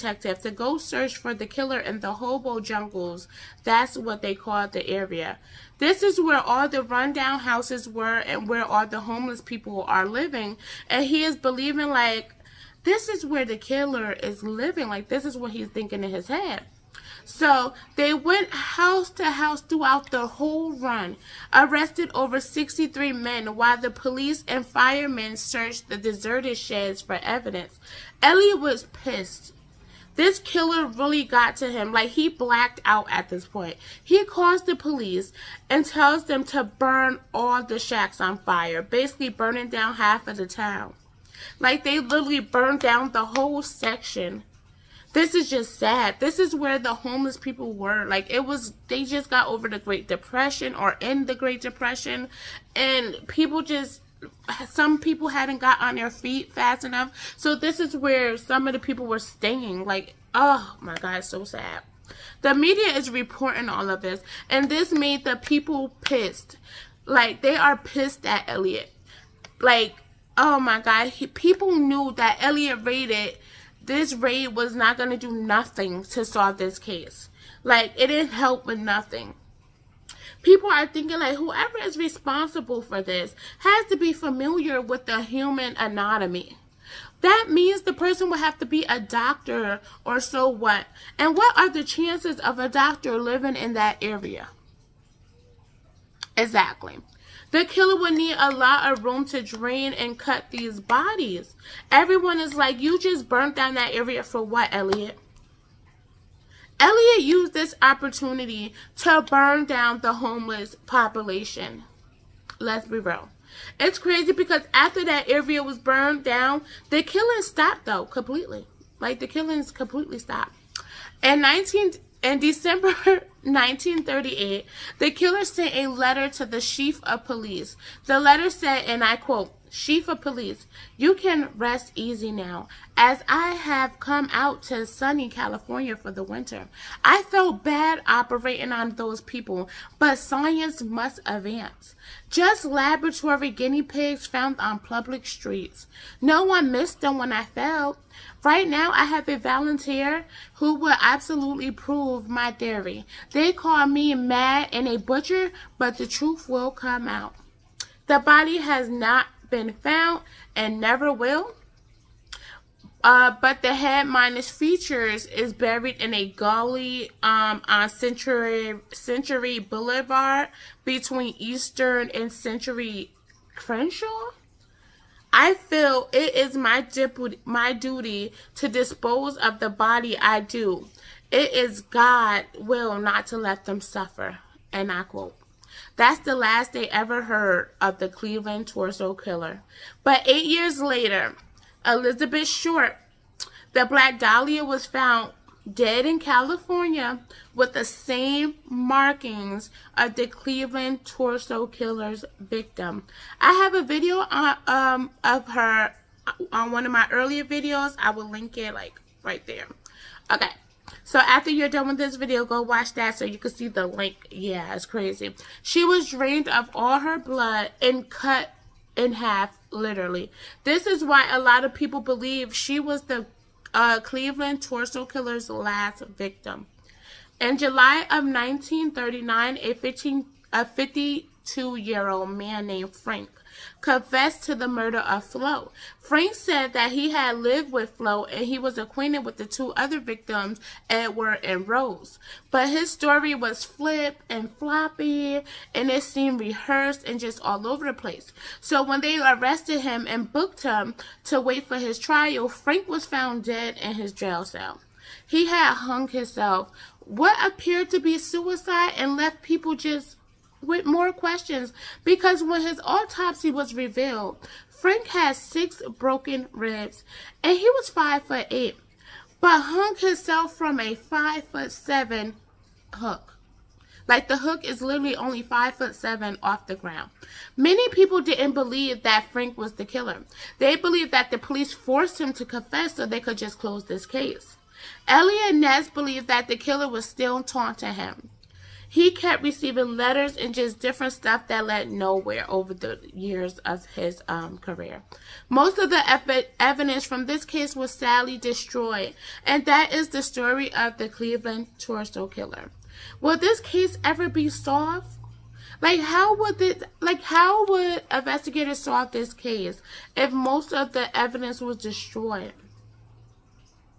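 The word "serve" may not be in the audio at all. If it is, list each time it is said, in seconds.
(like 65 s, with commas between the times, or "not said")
not said.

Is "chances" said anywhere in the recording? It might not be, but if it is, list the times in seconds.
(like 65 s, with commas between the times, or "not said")
91 s.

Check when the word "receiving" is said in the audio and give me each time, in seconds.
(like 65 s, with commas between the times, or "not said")
289 s.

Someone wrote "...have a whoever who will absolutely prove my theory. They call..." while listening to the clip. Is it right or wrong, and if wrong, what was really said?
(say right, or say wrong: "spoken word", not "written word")
wrong: "volunteer", not "whoever".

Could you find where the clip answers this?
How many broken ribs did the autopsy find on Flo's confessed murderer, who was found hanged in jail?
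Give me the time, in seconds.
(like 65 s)
265 s.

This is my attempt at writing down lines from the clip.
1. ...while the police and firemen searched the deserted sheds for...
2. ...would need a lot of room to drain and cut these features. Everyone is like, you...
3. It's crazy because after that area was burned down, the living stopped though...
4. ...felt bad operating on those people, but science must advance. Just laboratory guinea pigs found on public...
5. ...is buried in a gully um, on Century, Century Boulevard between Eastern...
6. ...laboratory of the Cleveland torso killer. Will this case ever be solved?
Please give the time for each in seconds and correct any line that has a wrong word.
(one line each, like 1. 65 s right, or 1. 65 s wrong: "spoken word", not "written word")
1. 23 s right
2. 97 s wrong: "bodies", not "features"
3. 113 s wrong: "killing", not "living"
4. 137 s right
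5. 165 s right
6. 300 s wrong: "story", not "laboratory".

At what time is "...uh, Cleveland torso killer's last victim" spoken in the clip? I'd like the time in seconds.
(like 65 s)
223 s.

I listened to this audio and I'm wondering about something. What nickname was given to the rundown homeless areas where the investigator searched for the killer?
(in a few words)
hobo jungles.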